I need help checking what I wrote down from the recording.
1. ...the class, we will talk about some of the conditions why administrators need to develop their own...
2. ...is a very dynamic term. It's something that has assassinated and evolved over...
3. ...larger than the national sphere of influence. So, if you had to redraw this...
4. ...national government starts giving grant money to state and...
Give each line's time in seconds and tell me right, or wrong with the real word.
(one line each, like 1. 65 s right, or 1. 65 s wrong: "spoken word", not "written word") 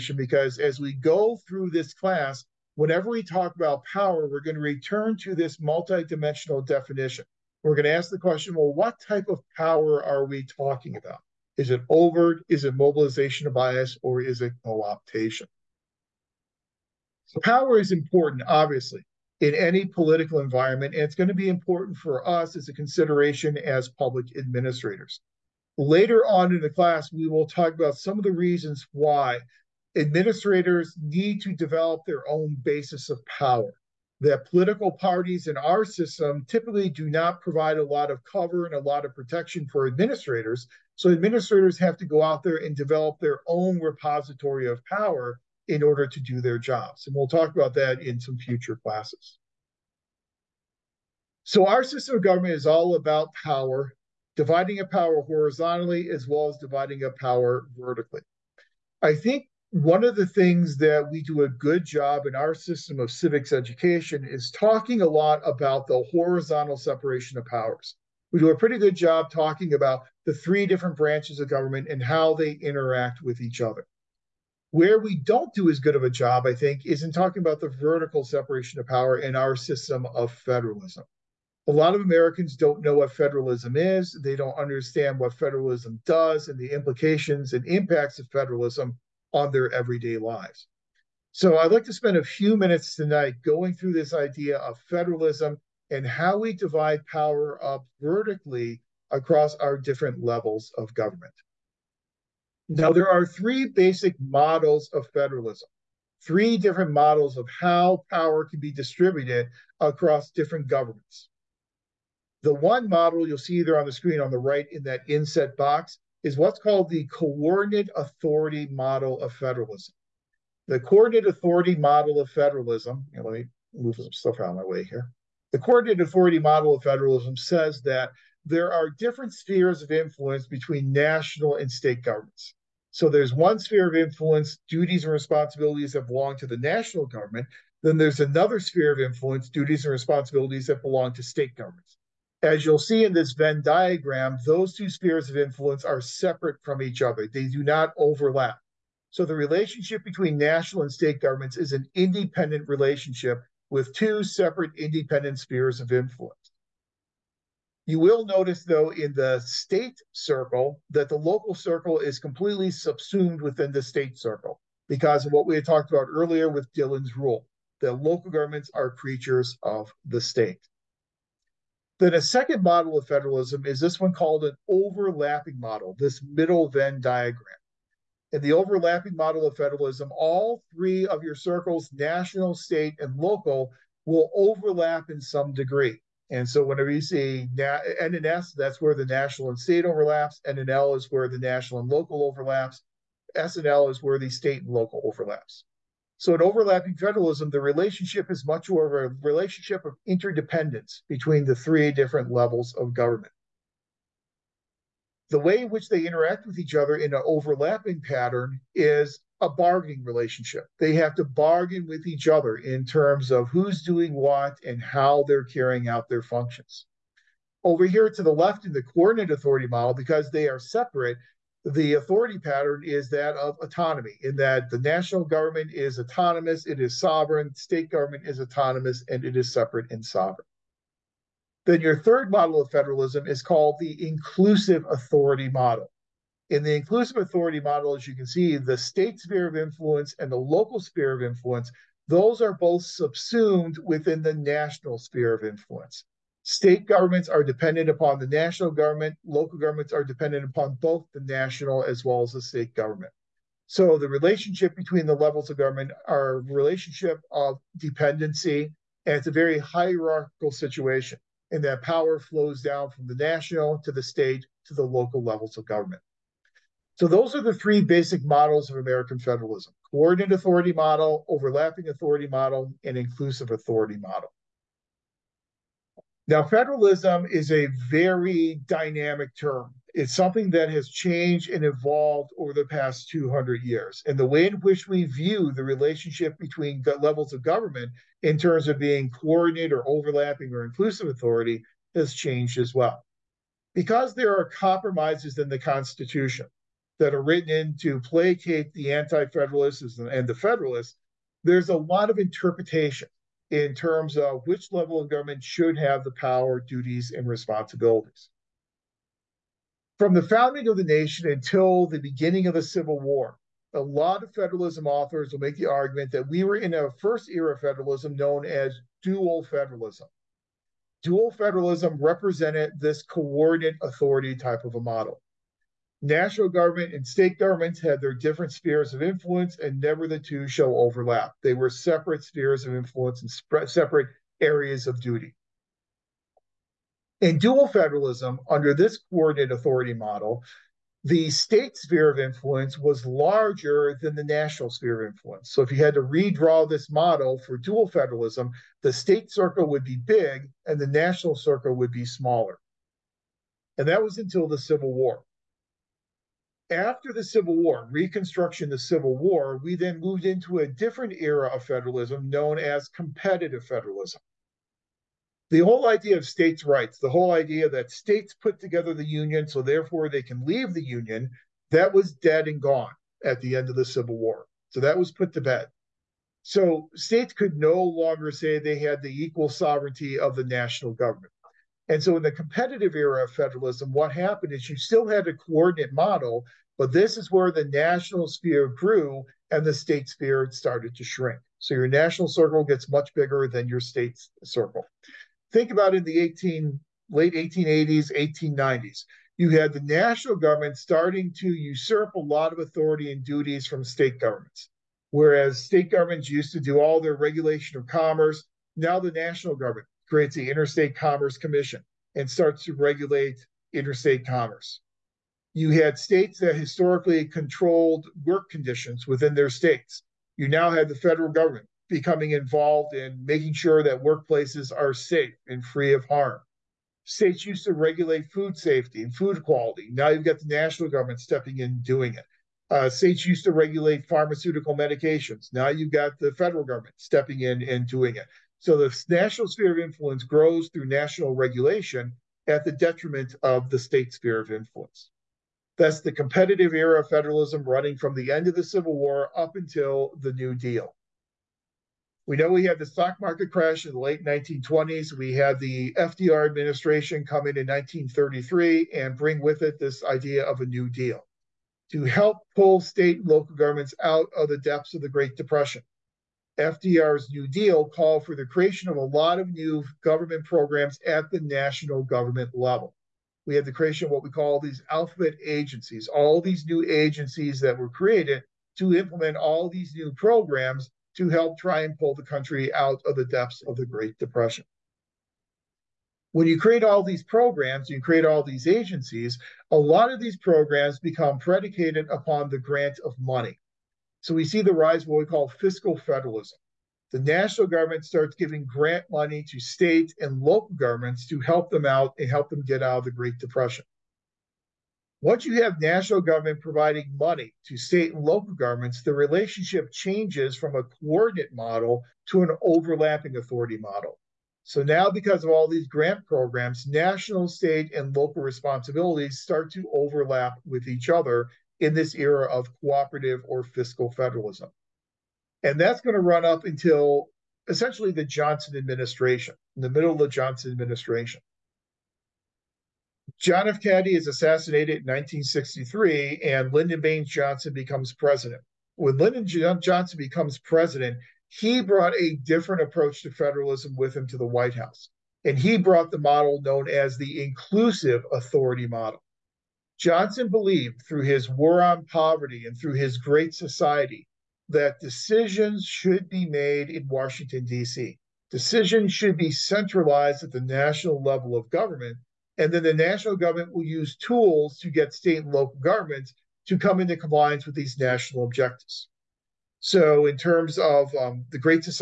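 1. 26 s wrong: "reasons", not "conditions"
2. 277 s wrong: "changed", not "assassinated"
3. 343 s right
4. 497 s right.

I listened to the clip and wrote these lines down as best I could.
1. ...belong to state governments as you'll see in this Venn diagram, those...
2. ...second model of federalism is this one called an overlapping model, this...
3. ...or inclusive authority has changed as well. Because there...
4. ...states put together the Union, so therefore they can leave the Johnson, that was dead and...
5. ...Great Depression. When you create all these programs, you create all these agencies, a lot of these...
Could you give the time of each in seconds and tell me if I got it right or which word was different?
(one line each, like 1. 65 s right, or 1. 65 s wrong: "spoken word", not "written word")
1. 140 s right
2. 172 s right
3. 290 s right
4. 367 s wrong: "Union", not "Johnson"
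5. 483 s right.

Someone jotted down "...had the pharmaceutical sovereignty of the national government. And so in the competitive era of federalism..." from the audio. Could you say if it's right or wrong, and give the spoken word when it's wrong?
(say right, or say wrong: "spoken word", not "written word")
wrong: "equal", not "pharmaceutical".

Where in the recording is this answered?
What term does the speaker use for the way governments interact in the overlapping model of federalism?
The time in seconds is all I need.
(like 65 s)
209 s.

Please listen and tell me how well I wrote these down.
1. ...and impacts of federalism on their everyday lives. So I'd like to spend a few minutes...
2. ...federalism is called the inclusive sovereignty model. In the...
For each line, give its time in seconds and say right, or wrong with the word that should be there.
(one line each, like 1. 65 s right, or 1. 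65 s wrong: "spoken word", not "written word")
1. 87 s right
2. 232 s wrong: "authority", not "sovereignty".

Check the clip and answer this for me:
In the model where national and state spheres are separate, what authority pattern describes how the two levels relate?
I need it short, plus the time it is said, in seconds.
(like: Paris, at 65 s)
autonomy, at 223 s.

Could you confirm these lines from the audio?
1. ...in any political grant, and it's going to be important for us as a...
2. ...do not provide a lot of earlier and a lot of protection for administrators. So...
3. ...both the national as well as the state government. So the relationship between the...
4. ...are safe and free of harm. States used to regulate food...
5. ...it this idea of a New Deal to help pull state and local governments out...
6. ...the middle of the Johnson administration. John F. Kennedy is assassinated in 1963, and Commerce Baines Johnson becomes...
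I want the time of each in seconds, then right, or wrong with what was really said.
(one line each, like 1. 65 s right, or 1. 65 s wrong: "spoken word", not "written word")
1. 19 s wrong: "environment", not "grant"
2. 36 s wrong: "cover", not "earlier"
3. 250 s right
4. 424 s right
5. 459 s right
6. 529 s wrong: "Lyndon", not "Commerce".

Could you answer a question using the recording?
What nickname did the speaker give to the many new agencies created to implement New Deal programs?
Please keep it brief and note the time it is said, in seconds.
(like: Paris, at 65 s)
alphabet agencies, at 474 s.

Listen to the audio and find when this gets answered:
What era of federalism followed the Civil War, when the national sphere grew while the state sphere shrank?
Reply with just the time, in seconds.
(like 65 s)
362 s.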